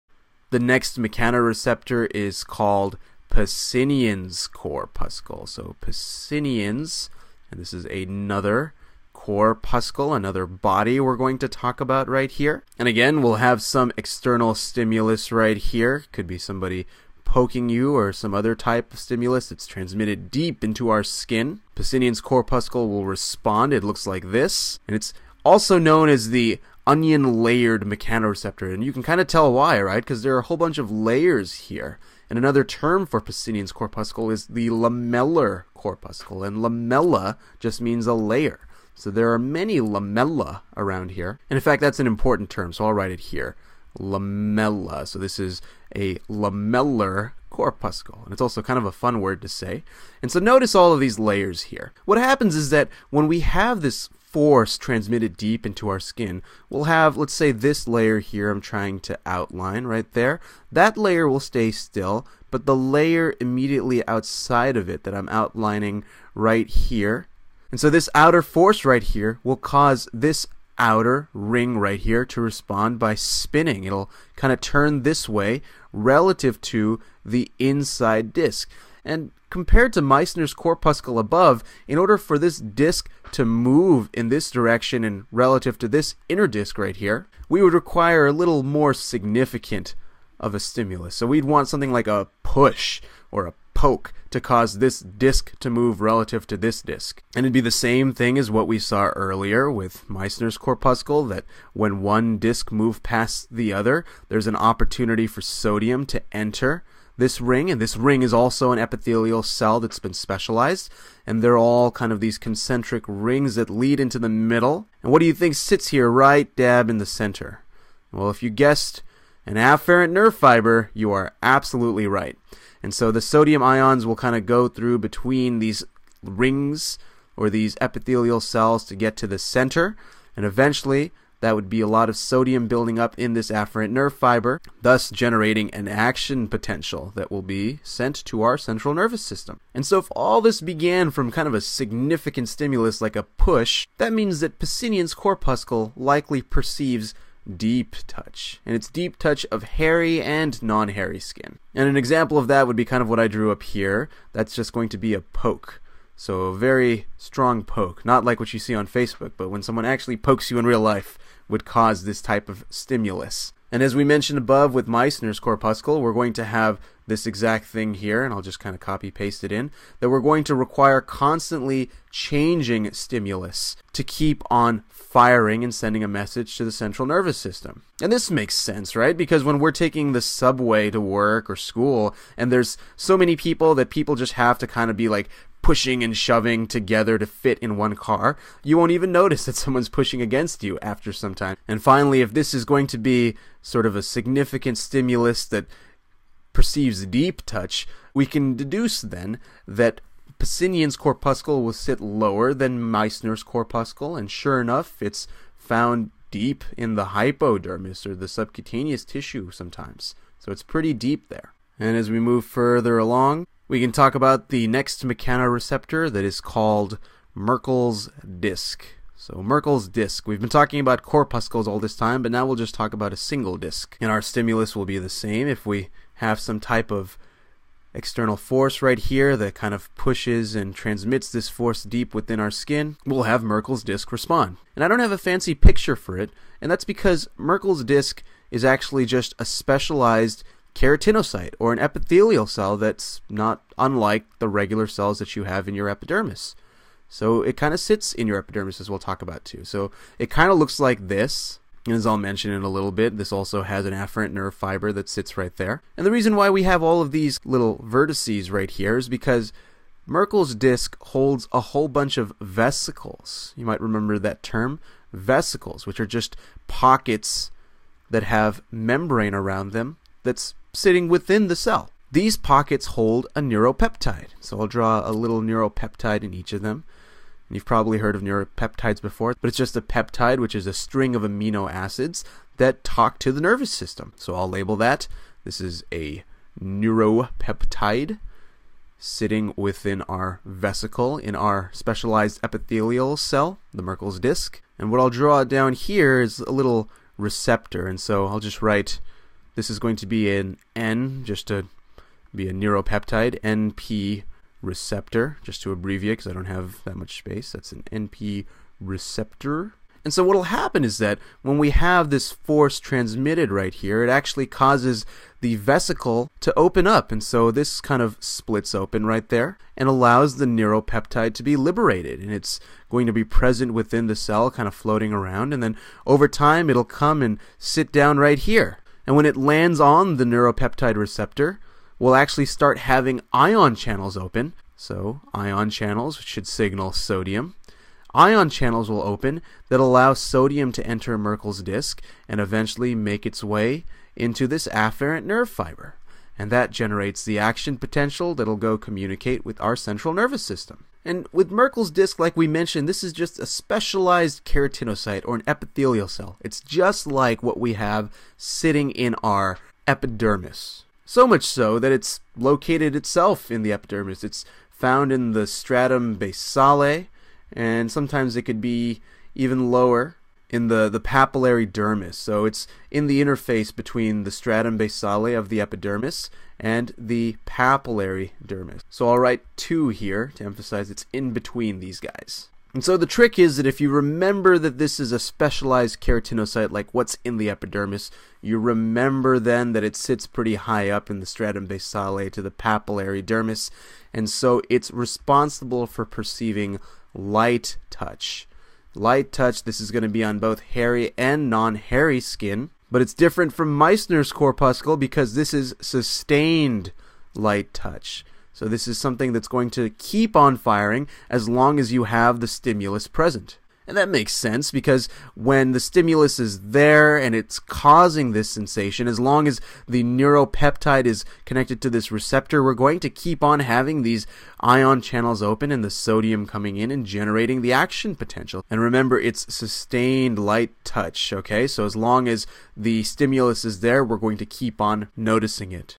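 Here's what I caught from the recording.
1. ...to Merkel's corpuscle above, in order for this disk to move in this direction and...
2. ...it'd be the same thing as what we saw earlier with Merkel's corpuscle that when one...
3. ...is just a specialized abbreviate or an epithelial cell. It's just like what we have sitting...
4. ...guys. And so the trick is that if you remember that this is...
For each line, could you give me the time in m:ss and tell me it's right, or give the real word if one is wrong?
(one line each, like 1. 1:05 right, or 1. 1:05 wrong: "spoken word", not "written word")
1. 1:19 wrong: "Meissner", not "Merkel"
2. 1:37 wrong: "Meissner", not "Merkel"
3. 5:53 wrong: "keratinocyte", not "abbreviate"
4. 6:21 right.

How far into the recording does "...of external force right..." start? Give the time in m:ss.
3:46.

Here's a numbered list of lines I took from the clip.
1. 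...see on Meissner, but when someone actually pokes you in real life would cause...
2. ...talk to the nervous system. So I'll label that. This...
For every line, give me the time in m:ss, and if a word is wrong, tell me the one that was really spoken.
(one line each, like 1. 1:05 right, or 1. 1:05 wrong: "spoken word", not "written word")
1. 2:38 wrong: "Facebook", not "Meissner"
2. 4:42 right.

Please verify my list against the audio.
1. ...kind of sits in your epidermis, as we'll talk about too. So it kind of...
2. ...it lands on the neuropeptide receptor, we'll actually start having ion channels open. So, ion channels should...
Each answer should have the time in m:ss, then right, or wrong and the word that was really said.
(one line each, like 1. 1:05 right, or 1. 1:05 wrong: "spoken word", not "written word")
1. 4:07 right
2. 5:29 right.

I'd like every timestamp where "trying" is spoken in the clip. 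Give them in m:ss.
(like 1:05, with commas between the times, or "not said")
0:58.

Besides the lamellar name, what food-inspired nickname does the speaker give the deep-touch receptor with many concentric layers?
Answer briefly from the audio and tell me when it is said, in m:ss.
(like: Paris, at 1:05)
onion layered mechanoreceptor, at 0:26.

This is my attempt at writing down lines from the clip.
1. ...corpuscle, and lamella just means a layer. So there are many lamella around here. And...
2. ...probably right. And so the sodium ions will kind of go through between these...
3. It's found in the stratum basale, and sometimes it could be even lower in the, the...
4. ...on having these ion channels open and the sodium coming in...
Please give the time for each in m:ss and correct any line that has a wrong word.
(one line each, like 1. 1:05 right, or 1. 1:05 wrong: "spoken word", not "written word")
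1. 0:35 right
2. 2:01 wrong: "absolutely", not "probably"
3. 6:04 right
4. 7:03 right.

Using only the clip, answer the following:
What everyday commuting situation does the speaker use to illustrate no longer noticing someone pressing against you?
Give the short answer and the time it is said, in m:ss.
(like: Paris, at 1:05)
taking the subway, at 2:59.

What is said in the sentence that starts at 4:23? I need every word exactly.
You might remember that term vesicles, which are just pockets that have membrane around them that's sitting within the cell.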